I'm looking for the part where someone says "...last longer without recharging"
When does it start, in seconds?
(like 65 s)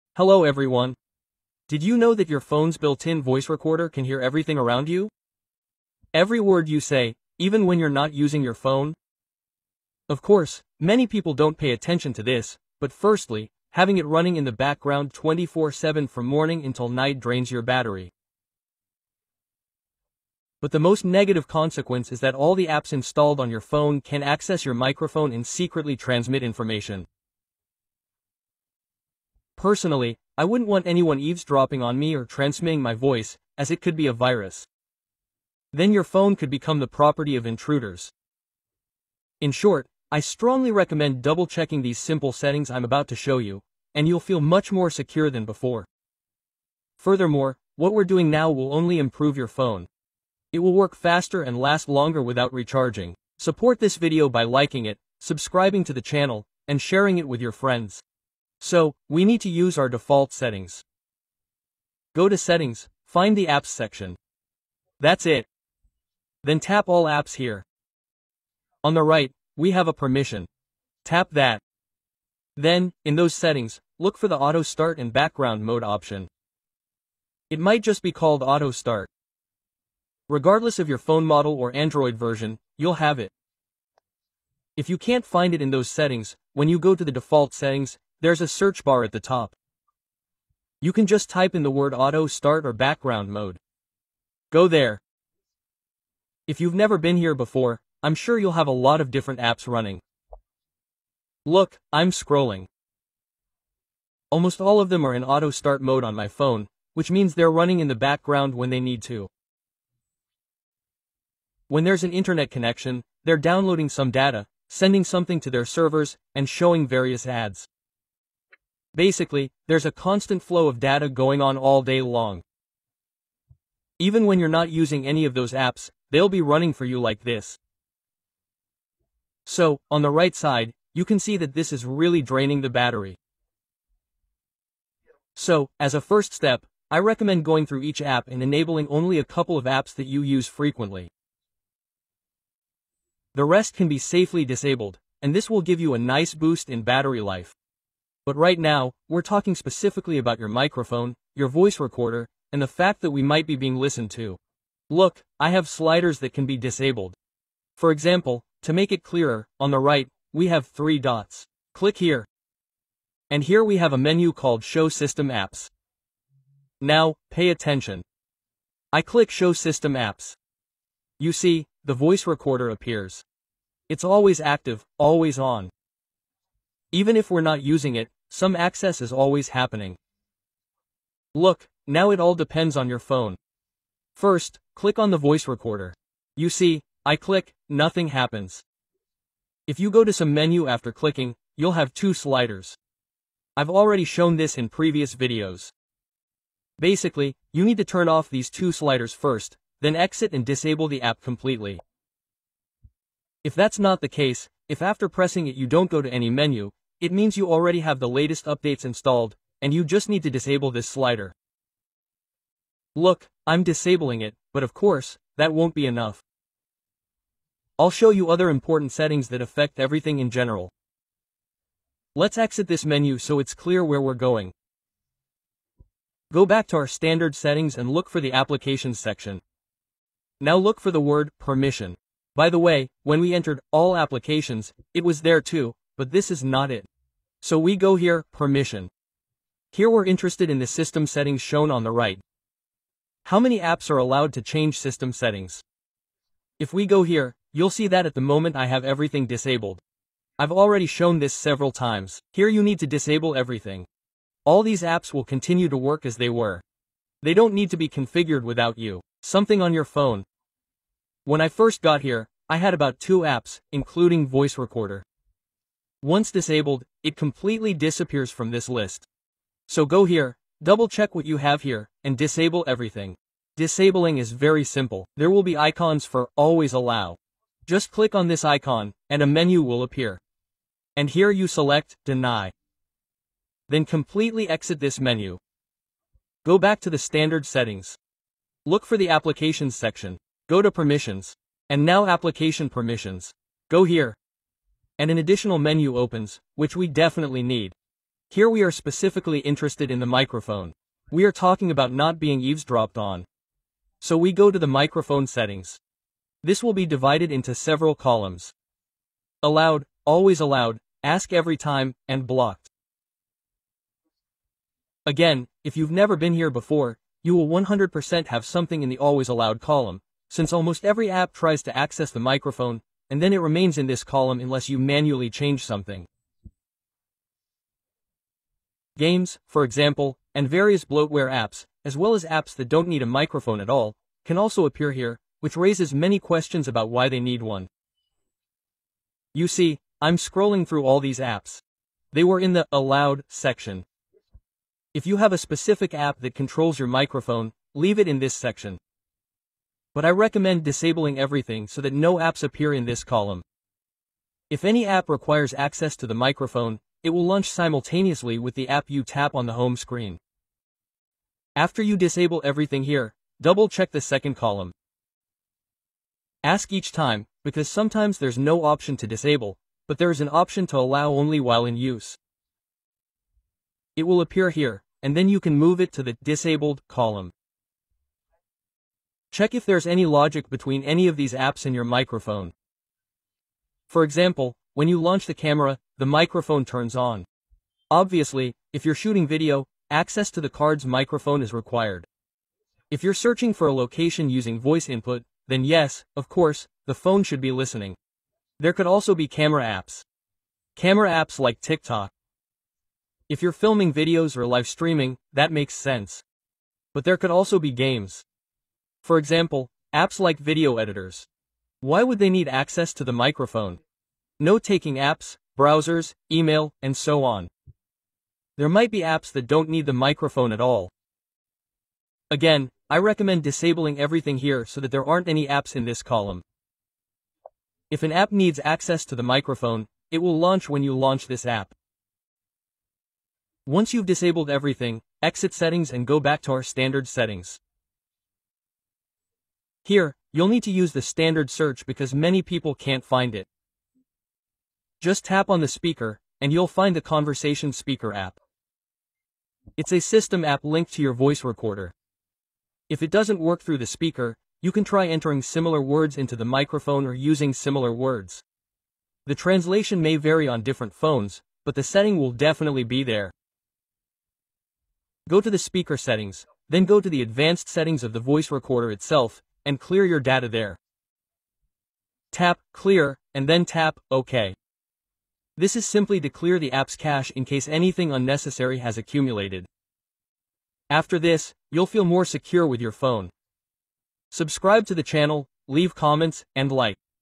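51 s.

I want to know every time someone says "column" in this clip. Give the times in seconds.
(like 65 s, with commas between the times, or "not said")
307 s, 319 s, 324 s, 353 s, 364 s, 376 s, 426 s.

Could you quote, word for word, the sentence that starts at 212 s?
Look, I'm disabling it, but of course, that won't be enough.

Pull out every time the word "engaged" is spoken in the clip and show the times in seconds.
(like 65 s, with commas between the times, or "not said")
not said.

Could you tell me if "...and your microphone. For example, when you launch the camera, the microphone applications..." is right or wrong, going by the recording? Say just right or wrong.
wrong.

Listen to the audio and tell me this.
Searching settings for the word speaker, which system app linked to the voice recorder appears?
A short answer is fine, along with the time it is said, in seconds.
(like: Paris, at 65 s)
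Conversation Speaker, at 447 s.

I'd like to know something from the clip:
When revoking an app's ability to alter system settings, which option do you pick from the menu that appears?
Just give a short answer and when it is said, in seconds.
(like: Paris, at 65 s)
Deny, at 282 s.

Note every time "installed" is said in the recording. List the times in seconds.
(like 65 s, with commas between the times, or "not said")
22 s, 208 s.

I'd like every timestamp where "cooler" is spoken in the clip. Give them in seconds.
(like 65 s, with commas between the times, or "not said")
not said.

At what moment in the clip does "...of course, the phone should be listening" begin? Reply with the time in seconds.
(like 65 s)
396 s.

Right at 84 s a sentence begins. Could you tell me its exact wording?
If you can't find it in those settings, when you go to the default settings, there's a search bar at the top.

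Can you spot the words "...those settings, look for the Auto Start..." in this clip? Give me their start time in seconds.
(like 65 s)
73 s.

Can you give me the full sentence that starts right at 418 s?
There might be apps that don't need the microphone at all.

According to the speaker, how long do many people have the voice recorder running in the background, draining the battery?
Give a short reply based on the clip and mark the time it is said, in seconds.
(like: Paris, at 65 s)
24-7, at 15 s.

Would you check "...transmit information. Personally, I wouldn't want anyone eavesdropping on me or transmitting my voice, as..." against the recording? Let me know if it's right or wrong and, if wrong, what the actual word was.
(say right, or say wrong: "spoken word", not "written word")
right.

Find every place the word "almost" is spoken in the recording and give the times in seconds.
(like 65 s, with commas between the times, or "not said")
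104 s, 320 s.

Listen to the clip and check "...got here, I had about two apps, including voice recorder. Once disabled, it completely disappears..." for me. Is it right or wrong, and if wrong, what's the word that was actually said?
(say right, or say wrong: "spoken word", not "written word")
right.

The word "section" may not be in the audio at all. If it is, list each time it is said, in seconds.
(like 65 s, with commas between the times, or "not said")
63 s, 228 s, 289 s, 343 s, 348 s.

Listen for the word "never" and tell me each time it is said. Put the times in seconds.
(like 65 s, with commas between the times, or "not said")
96 s, 315 s.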